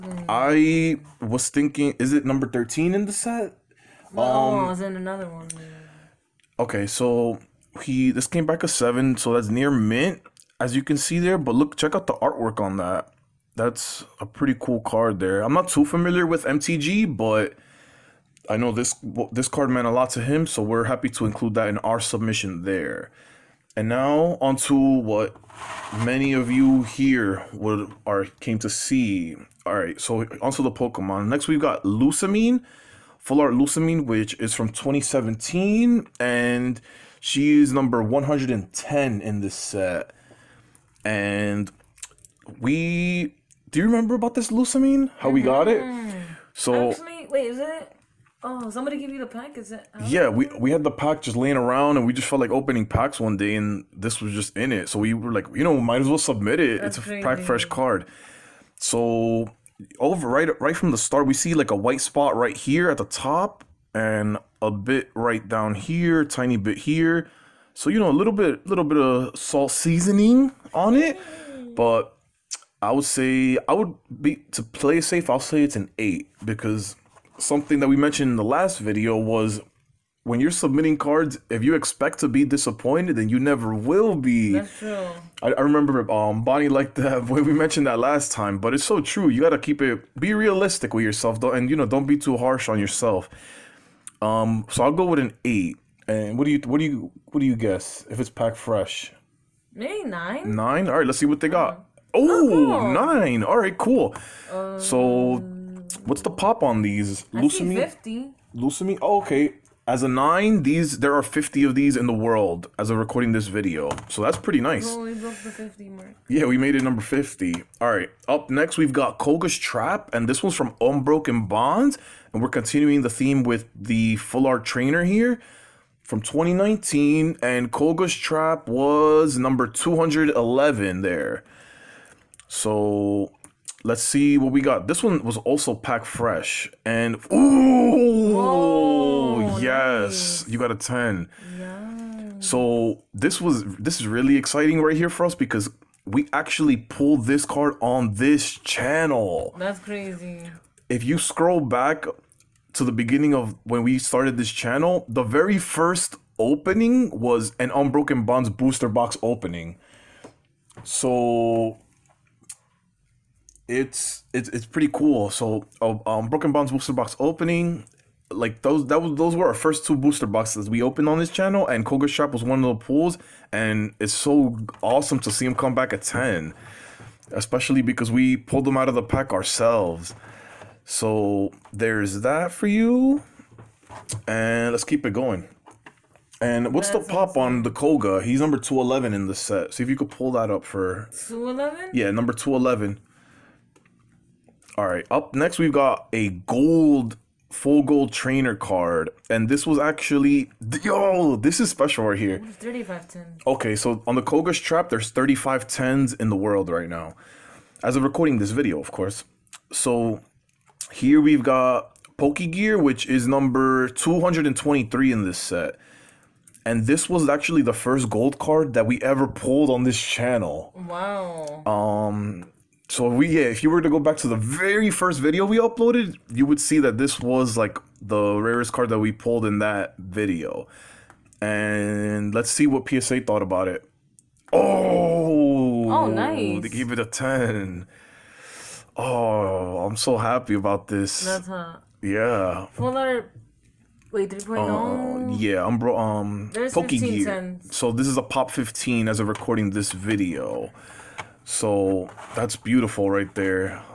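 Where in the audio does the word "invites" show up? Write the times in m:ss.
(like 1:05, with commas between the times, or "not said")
not said.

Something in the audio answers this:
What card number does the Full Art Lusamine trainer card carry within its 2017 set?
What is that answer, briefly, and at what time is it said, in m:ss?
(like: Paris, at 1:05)
110, at 0:37.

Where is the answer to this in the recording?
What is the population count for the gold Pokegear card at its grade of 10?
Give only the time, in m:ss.
4:08.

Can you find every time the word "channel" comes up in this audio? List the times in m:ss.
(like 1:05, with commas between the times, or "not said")
2:28, 2:34, 2:51, 3:40.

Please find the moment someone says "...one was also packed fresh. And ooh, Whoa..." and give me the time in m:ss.
2:15.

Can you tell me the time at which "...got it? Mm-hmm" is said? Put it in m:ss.
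0:45.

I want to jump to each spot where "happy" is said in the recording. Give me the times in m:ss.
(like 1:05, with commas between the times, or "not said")
0:20, 4:00.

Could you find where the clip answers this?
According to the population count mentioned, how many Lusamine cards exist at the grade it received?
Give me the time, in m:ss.
1:47.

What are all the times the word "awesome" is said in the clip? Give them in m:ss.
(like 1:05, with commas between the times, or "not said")
2:54, 3:07.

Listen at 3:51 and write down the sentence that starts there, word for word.
And let's see what PSA thought about it.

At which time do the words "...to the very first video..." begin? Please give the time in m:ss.
3:44.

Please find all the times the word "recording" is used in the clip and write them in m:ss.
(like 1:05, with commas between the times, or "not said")
1:52, 3:28, 4:09.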